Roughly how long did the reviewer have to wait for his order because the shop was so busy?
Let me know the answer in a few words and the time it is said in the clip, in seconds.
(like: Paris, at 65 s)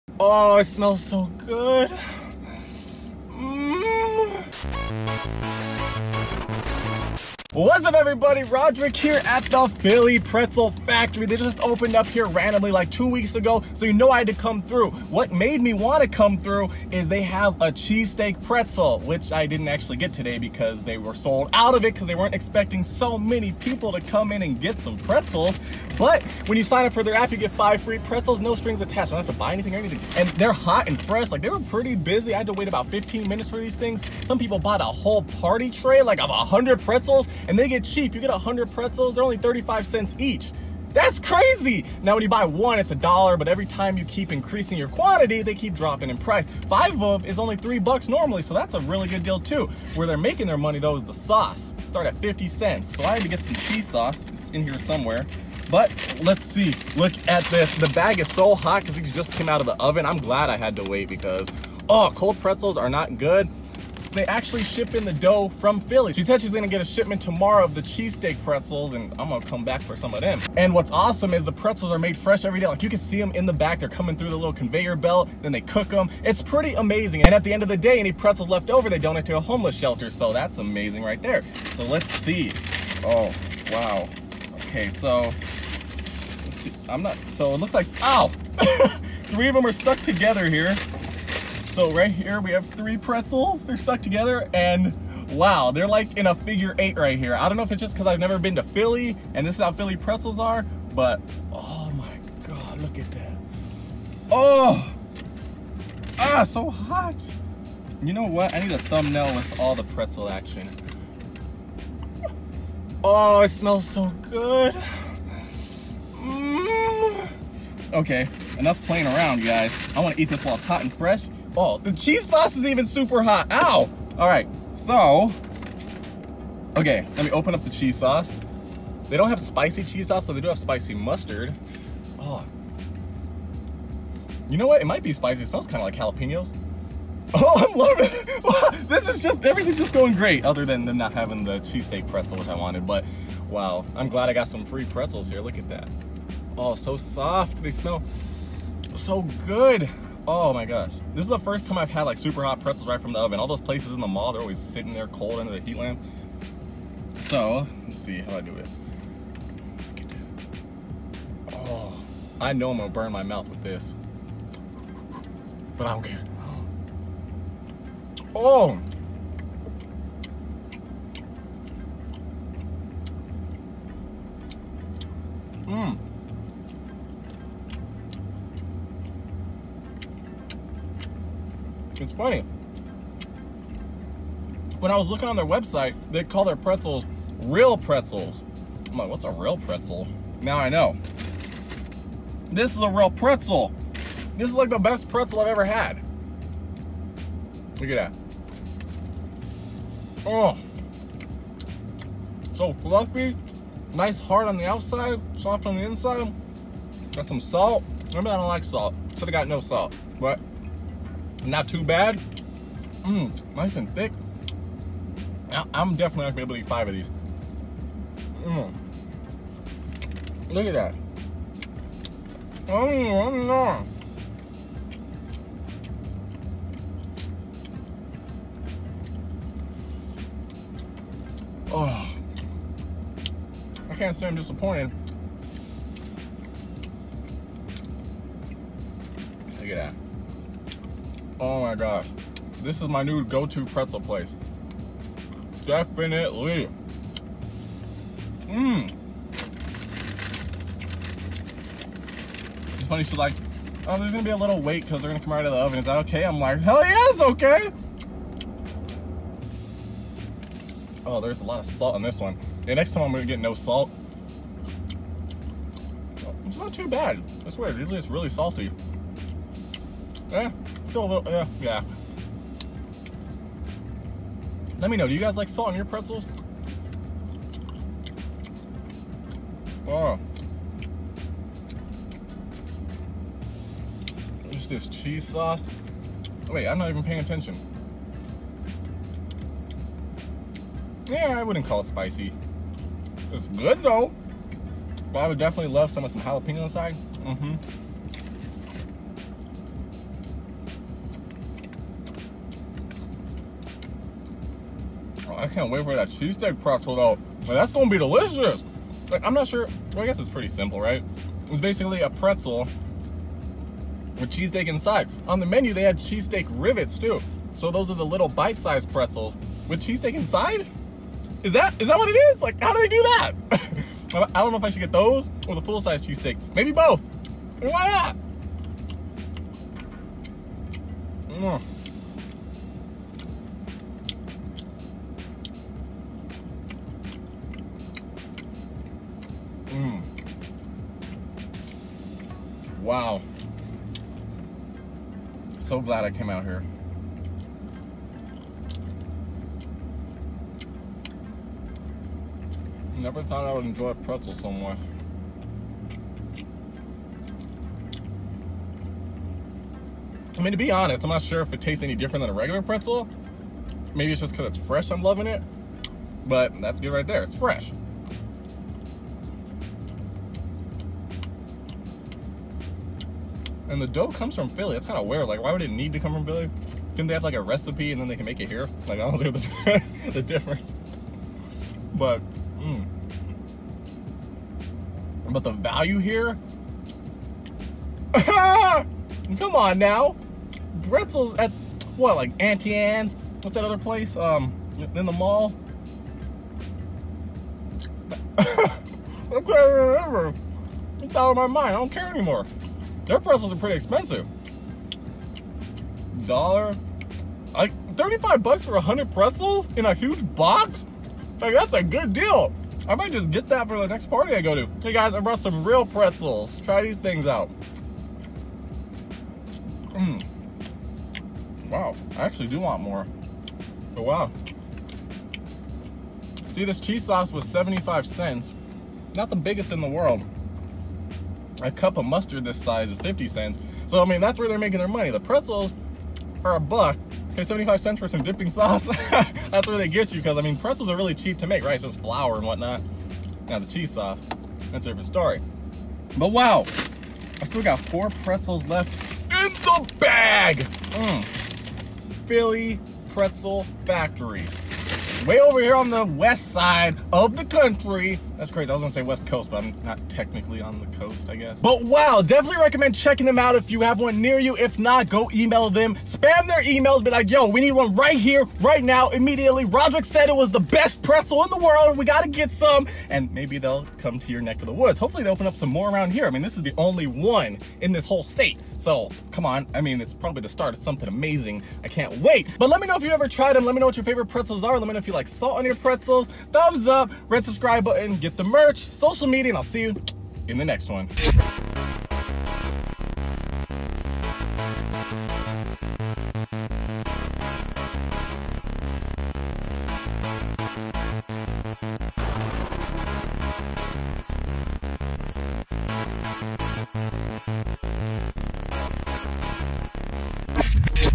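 15 minutes, at 32 s.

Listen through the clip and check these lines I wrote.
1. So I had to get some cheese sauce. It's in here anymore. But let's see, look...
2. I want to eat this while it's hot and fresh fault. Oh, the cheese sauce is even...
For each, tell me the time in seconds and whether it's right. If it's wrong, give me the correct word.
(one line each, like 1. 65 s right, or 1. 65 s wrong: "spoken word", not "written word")
1. 52 s wrong: "somewhere", not "anymore"
2. 119 s right.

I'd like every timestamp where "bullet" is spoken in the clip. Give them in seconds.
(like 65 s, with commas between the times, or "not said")
not said.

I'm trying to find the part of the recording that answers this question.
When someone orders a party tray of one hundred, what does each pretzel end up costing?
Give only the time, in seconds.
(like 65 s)
39 s.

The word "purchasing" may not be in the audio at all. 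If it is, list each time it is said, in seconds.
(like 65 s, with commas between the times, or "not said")
not said.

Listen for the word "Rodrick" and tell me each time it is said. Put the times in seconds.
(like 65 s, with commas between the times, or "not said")
8 s, 469 s.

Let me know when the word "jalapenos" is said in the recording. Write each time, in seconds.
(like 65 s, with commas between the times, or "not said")
135 s, 296 s.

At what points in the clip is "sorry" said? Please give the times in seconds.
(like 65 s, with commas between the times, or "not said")
not said.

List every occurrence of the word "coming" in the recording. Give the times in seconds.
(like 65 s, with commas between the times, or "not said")
73 s.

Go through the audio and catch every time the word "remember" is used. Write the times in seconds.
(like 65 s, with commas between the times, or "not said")
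208 s, 399 s.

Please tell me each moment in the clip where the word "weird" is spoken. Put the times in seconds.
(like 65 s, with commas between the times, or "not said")
267 s, 375 s.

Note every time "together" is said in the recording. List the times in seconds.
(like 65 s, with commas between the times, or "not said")
89 s, 94 s.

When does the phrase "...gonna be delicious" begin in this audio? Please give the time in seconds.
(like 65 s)
307 s.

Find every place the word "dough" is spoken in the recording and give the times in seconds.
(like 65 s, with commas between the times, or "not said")
65 s, 373 s.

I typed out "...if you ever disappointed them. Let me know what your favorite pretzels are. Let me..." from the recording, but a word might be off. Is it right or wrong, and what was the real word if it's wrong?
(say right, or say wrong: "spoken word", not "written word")
wrong: "tried", not "disappointed".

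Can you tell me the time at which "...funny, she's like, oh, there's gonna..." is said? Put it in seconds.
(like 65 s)
252 s.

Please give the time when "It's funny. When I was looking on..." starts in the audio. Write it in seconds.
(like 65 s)
182 s.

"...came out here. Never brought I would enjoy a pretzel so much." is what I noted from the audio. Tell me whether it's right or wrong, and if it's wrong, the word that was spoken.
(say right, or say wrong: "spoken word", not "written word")
wrong: "thought", not "brought".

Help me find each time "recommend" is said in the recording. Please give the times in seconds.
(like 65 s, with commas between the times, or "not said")
462 s.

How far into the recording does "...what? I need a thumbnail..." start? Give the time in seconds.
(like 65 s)
108 s.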